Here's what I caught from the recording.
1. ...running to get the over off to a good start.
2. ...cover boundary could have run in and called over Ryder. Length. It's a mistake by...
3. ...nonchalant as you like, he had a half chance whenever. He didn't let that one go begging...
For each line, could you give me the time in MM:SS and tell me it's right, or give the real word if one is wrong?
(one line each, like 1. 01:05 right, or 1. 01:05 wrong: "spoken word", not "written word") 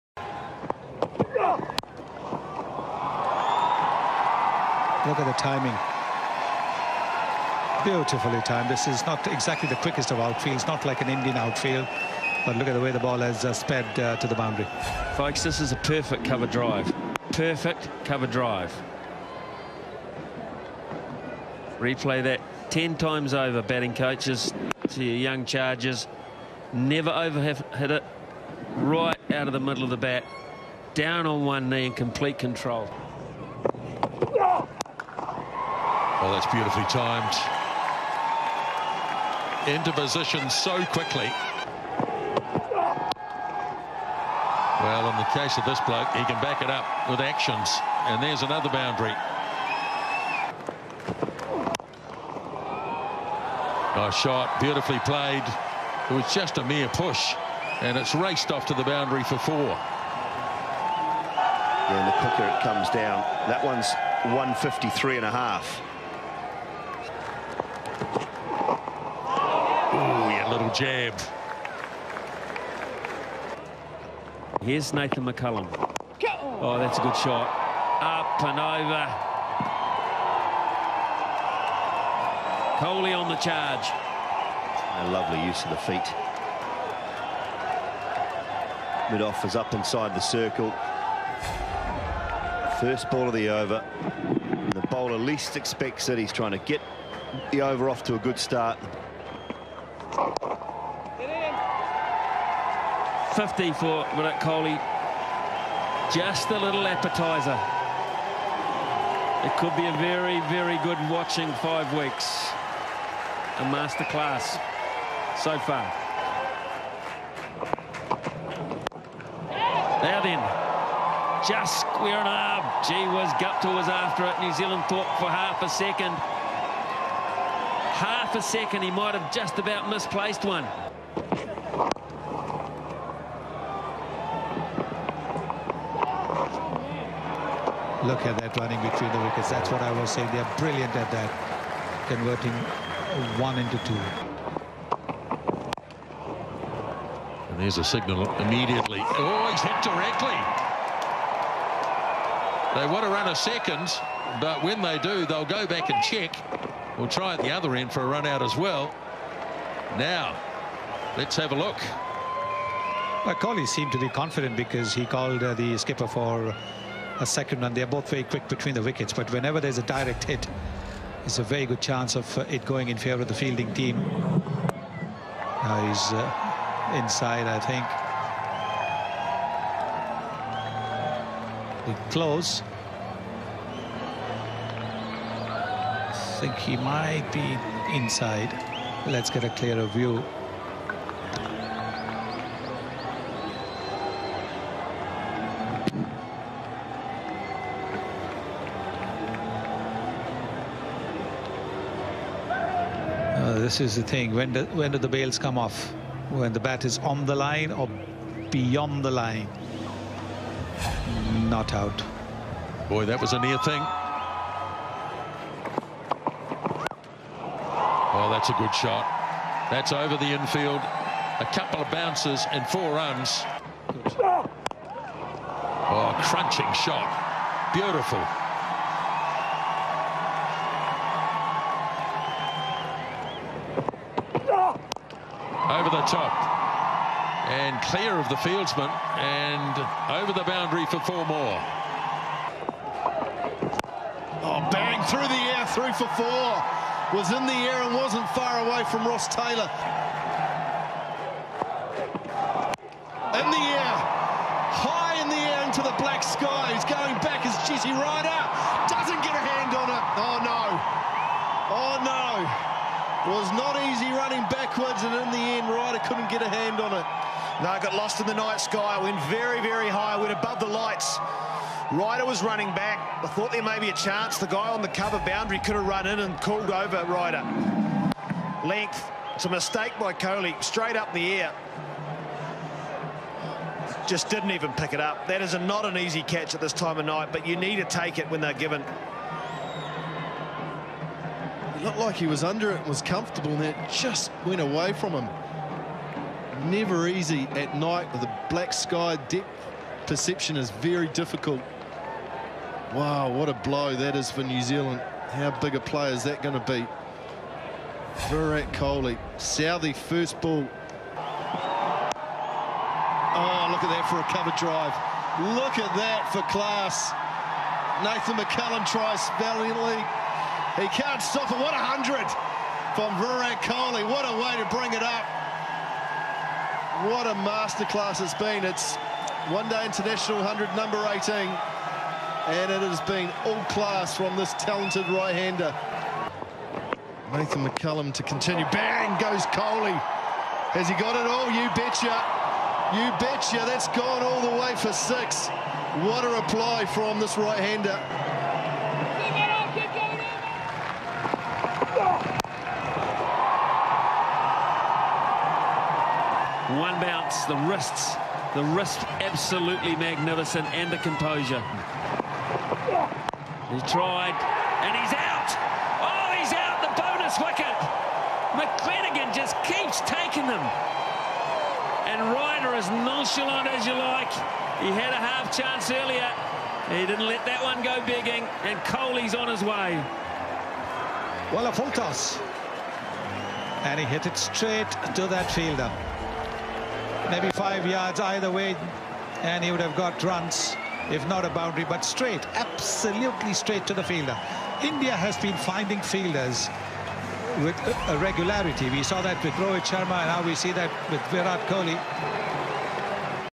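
1. 01:36 wrong: "trying", not "running"
2. 04:34 right
3. 06:12 wrong: "earlier", not "whenever".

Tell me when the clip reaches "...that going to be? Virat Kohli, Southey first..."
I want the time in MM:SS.
05:06.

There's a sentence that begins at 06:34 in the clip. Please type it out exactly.
India has been finding fielders with a regularity.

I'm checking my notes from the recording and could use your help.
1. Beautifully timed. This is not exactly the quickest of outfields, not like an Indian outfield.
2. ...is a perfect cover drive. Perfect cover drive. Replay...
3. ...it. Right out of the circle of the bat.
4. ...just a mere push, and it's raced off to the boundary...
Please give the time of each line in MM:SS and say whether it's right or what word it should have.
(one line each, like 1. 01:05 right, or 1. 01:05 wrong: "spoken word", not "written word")
1. 00:07 right
2. 00:15 right
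3. 00:27 wrong: "middle", not "circle"
4. 00:56 right.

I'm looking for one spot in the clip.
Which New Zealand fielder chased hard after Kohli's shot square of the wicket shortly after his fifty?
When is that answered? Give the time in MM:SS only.
02:03.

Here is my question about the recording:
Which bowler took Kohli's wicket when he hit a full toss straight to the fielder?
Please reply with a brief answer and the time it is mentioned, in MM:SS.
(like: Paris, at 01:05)
McClenaghan, at 06:08.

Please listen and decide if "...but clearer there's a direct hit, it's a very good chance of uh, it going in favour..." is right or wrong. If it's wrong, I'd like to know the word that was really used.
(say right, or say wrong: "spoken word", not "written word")
wrong: "whenever", not "clearer".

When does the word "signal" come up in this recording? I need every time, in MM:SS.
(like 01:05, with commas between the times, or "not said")
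02:27.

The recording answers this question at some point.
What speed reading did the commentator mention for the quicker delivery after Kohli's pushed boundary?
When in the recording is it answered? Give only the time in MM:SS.
01:04.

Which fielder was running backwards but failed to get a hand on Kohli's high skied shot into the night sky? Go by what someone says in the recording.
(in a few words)
Jesse Ryder.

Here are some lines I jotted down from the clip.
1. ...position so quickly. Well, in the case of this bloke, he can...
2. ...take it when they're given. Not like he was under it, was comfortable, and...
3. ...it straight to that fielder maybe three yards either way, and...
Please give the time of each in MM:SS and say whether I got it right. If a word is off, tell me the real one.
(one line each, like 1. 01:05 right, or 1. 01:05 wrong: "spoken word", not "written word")
1. 00:39 right
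2. 04:47 right
3. 06:24 wrong: "five", not "three".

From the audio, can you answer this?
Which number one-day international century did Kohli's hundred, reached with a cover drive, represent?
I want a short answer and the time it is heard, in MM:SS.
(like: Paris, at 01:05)
18, at 05:31.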